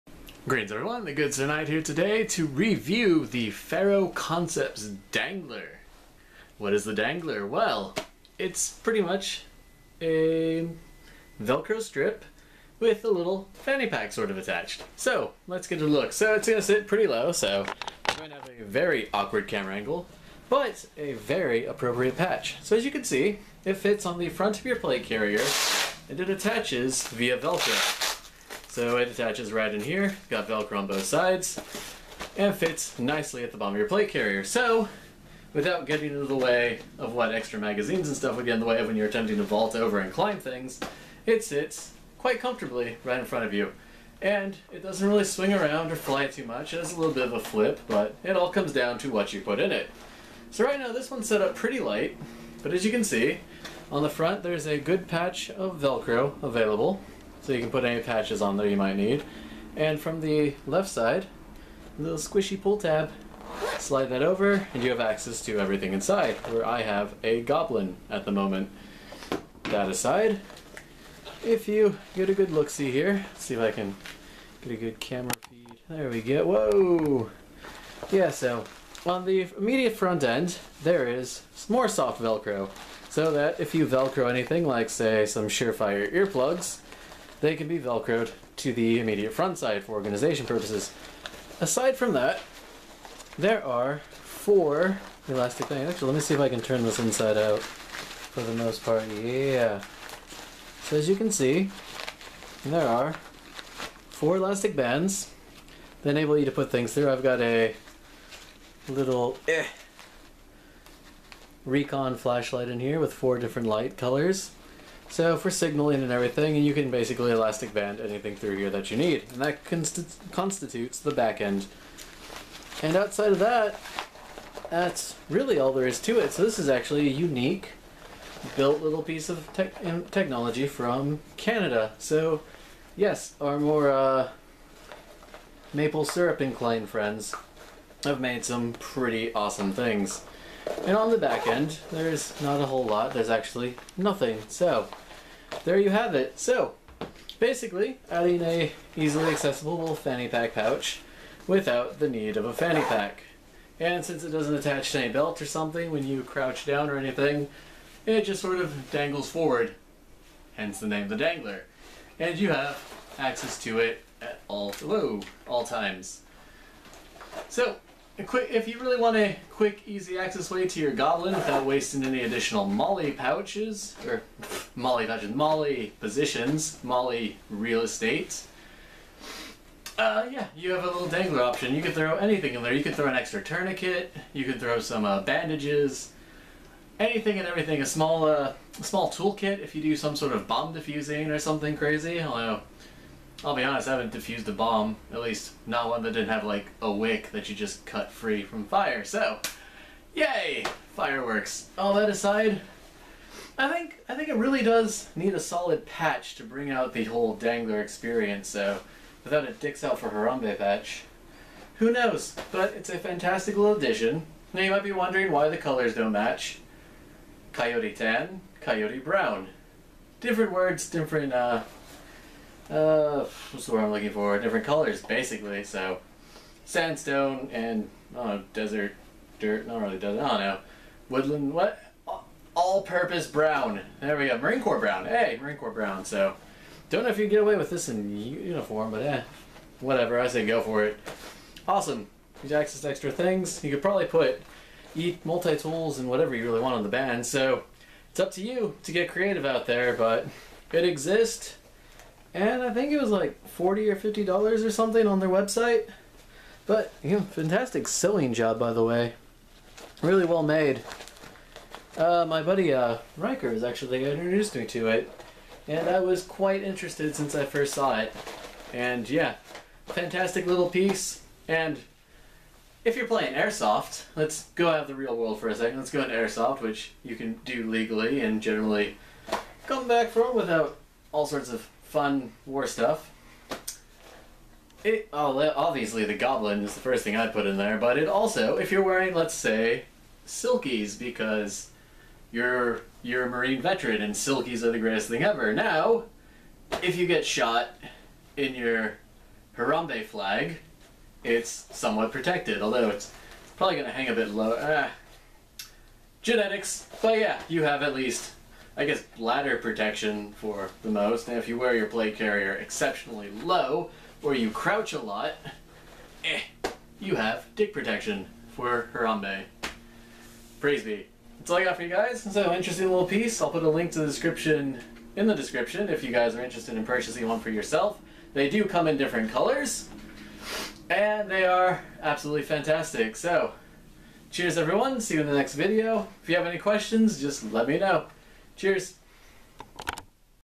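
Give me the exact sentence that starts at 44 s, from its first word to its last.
And it doesn't really swing around or fly too much.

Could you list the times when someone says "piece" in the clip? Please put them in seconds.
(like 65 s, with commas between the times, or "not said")
129 s, 270 s, 323 s.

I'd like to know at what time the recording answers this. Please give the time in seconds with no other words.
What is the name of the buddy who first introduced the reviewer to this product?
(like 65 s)
263 s.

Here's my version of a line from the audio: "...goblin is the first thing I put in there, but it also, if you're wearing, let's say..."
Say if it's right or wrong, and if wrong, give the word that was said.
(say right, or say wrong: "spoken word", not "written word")
right.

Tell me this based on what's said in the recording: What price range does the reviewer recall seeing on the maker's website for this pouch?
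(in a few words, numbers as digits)
$40 or $50.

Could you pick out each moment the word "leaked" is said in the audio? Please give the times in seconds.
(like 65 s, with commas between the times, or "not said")
not said.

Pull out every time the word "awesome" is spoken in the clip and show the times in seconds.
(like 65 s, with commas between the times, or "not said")
139 s, 241 s.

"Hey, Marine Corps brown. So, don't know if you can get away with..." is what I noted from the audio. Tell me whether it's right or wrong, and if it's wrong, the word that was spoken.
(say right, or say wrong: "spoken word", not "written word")
right.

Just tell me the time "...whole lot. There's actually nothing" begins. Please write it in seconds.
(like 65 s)
142 s.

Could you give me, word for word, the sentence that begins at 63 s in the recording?
Slide that over and you have access to everything inside, where I have a goblin at the moment.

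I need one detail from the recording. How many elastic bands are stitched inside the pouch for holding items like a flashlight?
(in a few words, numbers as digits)
4.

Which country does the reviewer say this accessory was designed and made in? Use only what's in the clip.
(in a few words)
Canada.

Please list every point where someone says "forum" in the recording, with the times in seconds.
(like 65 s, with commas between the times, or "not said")
not said.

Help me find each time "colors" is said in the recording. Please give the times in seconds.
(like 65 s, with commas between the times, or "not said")
113 s, 215 s, 224 s, 329 s.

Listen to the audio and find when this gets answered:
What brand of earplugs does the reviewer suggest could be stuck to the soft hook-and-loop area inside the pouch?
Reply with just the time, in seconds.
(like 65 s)
85 s.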